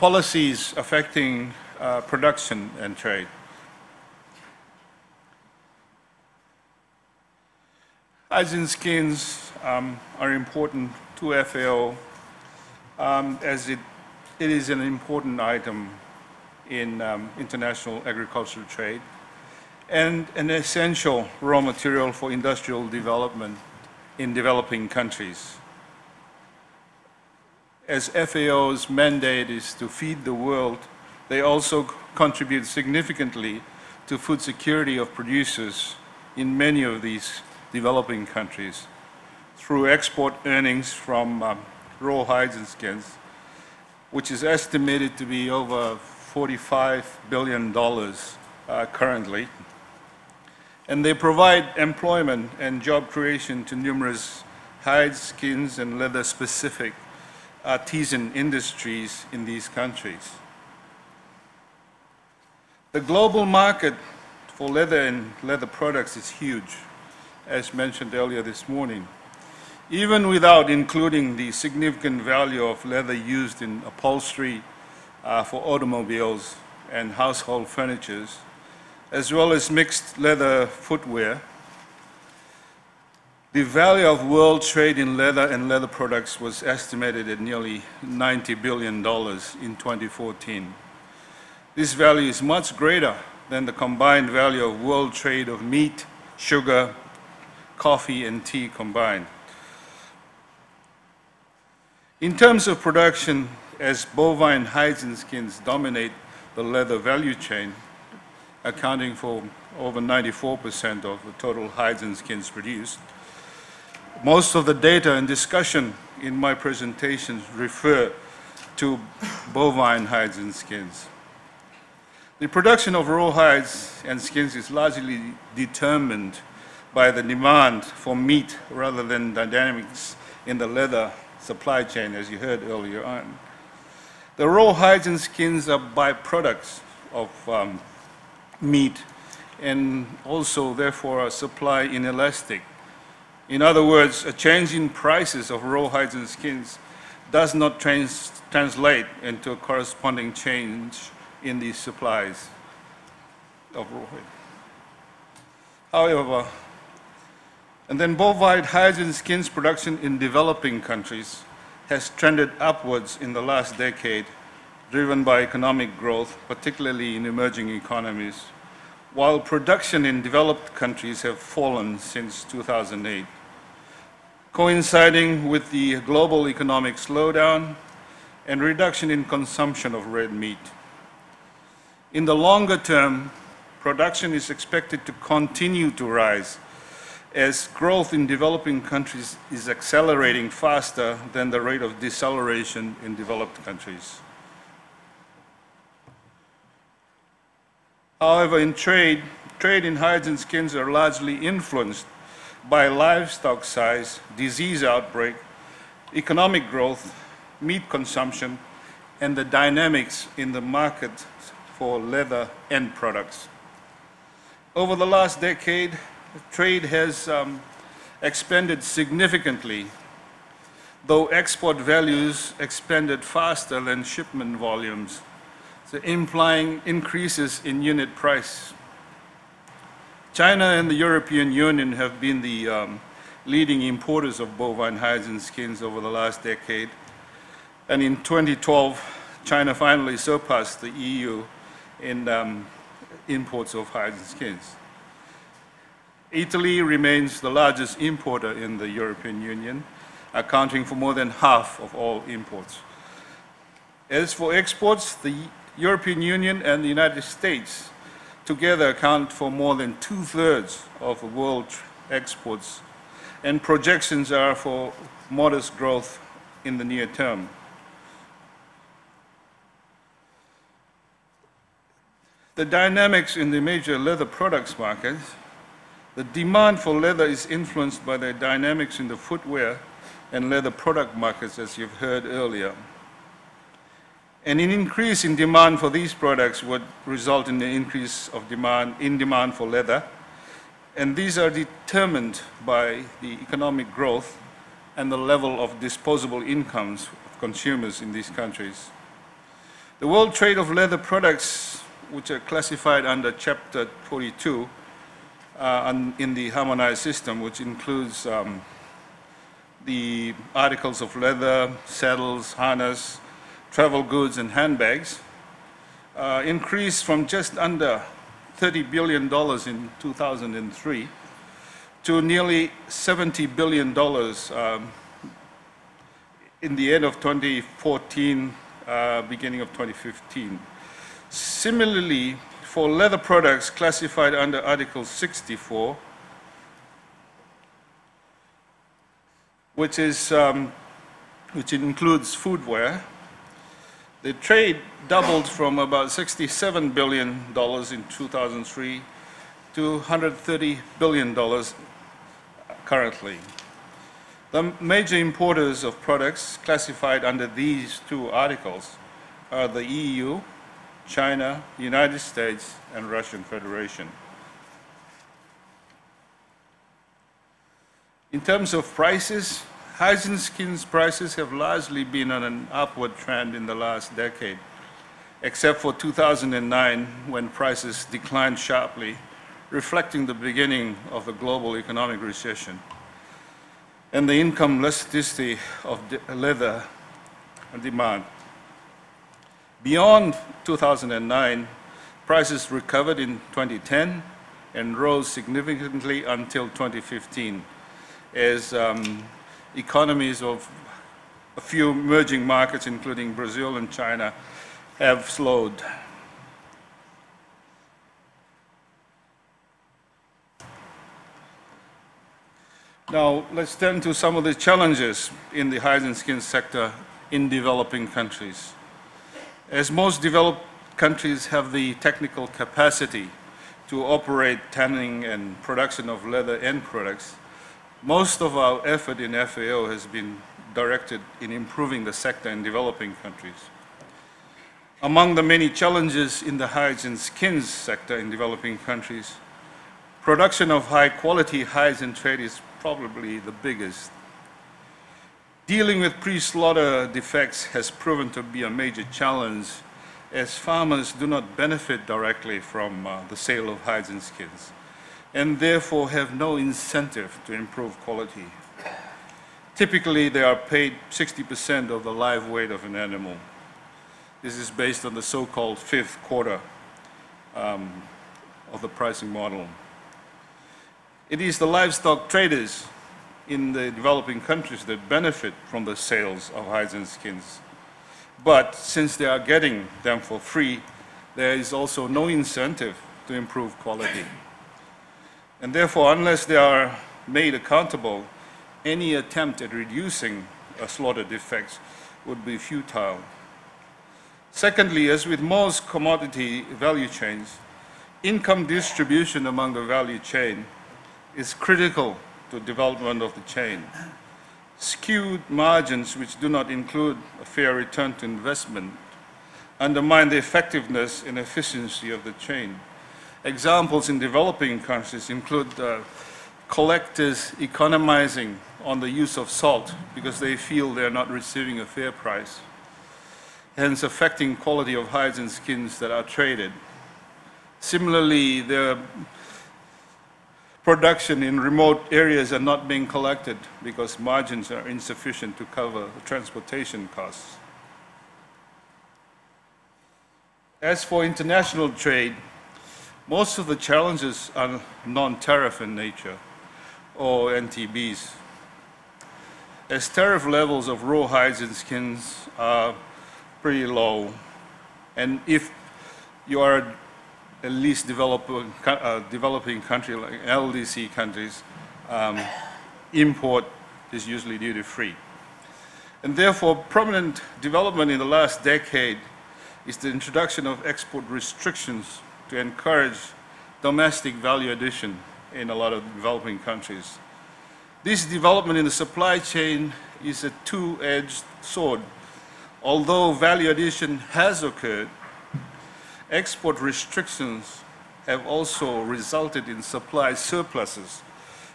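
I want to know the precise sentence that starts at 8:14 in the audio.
Secondly, as with most commodity value chains, income distribution among the value chain is critical to development of the chain.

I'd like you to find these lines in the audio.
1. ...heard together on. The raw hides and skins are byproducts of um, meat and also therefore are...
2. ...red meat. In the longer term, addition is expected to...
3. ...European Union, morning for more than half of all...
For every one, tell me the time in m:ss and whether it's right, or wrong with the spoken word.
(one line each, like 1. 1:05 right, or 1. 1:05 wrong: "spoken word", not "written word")
1. 2:12 wrong: "earlier", not "together"
2. 3:00 wrong: "production", not "addition"
3. 4:08 wrong: "accounting", not "morning".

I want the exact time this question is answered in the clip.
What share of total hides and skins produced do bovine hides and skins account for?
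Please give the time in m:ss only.
1:49.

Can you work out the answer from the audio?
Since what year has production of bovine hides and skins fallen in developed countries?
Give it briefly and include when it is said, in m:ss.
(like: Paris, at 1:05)
2008, at 2:52.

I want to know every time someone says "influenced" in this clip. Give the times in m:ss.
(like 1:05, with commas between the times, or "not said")
3:21, 4:37.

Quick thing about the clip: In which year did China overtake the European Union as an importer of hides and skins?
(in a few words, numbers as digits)
2012.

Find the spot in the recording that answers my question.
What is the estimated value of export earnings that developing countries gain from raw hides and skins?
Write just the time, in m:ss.
0:45.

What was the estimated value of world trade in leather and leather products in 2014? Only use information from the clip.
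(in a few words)
nearly $90 billion.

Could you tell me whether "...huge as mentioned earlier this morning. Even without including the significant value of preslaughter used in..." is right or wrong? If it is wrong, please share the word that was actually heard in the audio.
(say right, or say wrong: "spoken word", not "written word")
wrong: "leather", not "preslaughter".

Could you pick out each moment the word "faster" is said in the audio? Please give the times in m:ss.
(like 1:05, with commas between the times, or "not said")
3:10, 3:43.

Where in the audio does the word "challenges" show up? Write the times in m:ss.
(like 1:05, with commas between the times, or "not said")
6:54, 7:15, 7:29, 9:03.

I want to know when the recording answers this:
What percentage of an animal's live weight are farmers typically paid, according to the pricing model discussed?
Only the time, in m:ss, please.
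7:41.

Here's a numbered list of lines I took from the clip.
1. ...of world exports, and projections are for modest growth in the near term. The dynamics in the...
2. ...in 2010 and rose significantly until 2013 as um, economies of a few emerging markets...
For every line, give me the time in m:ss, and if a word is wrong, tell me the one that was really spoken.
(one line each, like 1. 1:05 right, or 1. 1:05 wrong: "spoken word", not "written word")
1. 4:20 right
2. 6:33 wrong: "2015", not "2013".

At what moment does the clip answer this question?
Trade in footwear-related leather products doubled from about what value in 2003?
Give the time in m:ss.
5:46.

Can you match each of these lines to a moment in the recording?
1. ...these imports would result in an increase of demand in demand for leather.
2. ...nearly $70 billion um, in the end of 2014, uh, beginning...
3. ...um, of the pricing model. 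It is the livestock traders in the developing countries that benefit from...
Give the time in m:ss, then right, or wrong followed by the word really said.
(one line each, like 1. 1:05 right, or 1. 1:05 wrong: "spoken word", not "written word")
1. 4:45 wrong: "products", not "imports"
2. 5:22 right
3. 7:47 right.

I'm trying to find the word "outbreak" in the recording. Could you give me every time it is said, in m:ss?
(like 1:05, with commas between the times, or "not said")
3:24.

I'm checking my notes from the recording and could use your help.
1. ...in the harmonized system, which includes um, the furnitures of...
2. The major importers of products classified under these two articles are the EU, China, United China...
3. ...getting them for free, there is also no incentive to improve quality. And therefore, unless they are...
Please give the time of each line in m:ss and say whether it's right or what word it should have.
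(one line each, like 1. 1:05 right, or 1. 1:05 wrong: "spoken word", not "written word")
1. 5:06 wrong: "articles", not "furnitures"
2. 5:54 wrong: "States", not "China"
3. 7:59 right.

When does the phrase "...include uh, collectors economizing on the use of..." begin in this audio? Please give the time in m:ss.
8:35.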